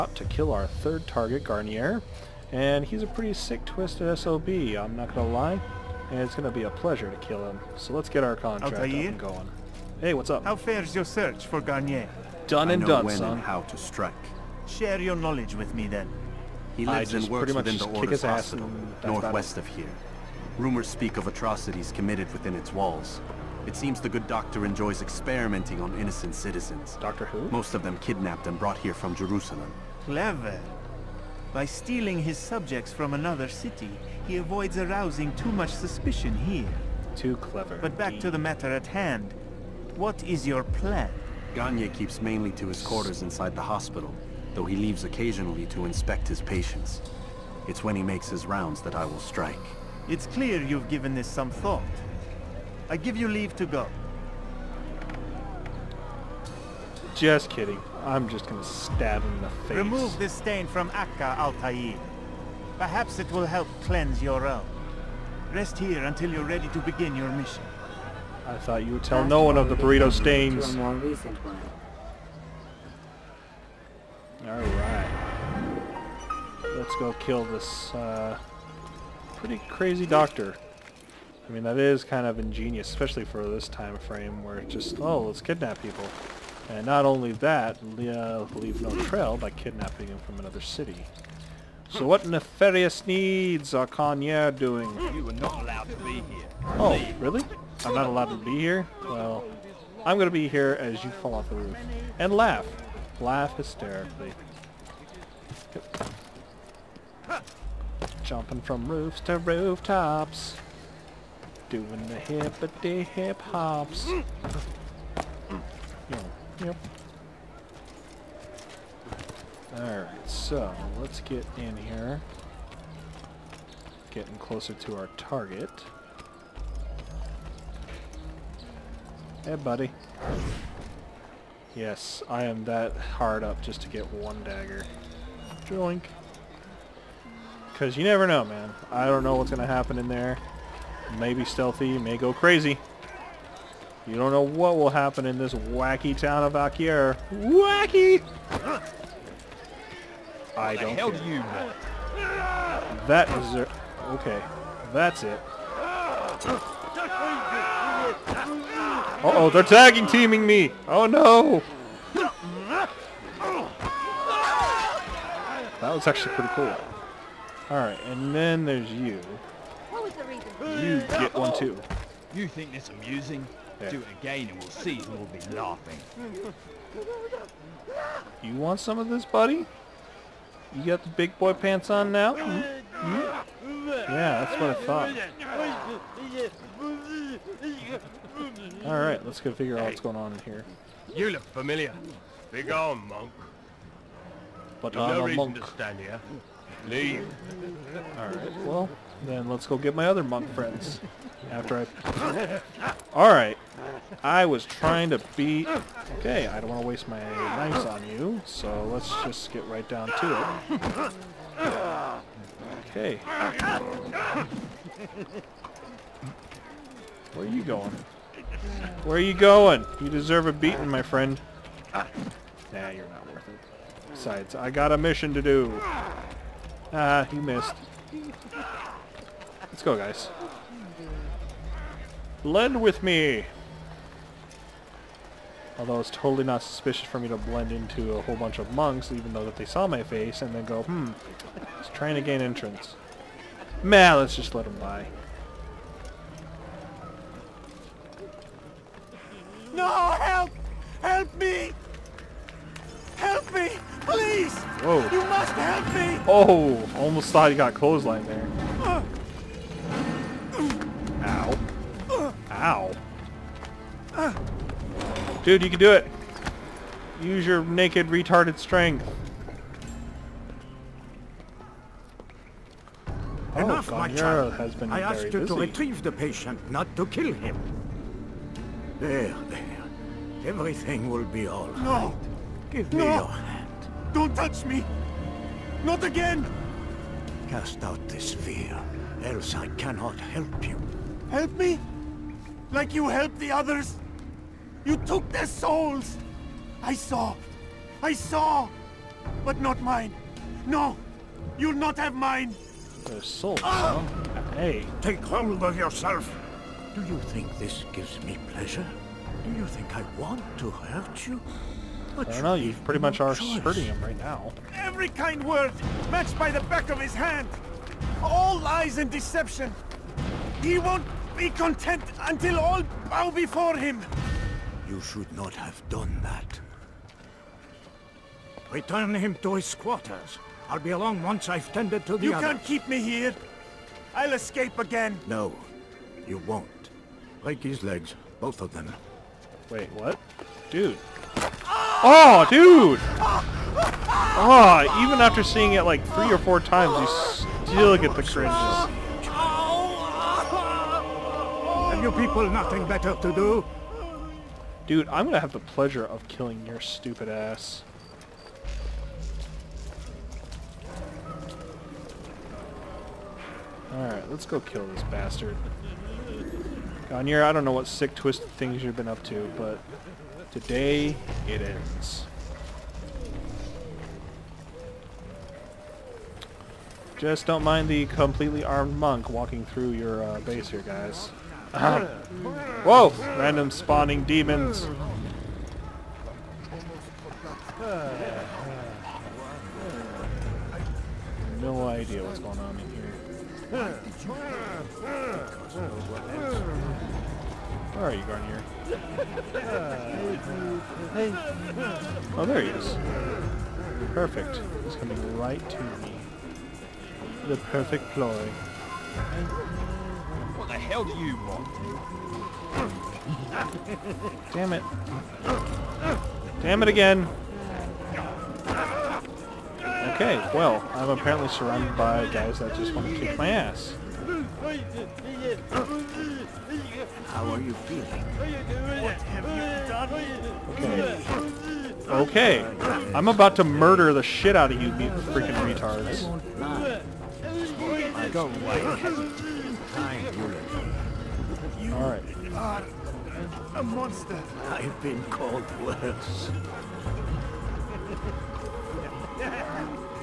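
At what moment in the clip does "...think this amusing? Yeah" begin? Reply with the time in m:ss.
2:52.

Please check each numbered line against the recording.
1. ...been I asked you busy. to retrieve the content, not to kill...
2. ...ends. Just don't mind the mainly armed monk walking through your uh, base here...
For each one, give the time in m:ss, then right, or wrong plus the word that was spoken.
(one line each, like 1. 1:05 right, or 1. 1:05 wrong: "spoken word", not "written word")
1. 4:34 wrong: "patient", not "content"
2. 6:11 wrong: "completely", not "mainly".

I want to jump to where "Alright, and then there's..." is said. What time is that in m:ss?
2:47.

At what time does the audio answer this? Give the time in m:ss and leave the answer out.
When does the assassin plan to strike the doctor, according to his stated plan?
0:47.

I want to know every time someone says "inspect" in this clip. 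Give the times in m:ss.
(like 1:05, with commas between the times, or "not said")
0:45.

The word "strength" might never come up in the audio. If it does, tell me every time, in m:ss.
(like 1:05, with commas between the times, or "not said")
4:28.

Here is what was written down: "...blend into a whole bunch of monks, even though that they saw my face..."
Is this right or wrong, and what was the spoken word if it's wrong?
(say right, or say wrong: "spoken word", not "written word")
right.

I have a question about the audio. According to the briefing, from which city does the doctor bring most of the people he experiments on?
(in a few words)
Jerusalem.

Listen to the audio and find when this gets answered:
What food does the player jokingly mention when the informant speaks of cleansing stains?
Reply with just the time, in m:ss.
1:09.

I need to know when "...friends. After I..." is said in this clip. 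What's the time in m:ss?
3:20.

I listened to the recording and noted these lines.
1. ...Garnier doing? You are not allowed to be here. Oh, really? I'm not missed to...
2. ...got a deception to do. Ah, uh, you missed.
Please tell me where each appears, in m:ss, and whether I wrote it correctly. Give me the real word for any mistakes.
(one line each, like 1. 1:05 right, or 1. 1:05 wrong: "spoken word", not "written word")
1. 1:33 wrong: "allowed", not "missed"
2. 3:44 wrong: "mission", not "deception".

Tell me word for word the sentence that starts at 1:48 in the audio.
Jumping from roofs to rooftops doing the hippity hip hops.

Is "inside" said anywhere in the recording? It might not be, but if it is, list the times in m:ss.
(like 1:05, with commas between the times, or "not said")
0:43.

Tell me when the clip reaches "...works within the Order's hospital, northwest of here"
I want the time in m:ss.
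0:17.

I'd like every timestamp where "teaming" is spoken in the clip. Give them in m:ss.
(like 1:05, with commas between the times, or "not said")
2:40.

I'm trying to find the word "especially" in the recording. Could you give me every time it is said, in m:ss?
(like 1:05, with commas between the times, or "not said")
1:22.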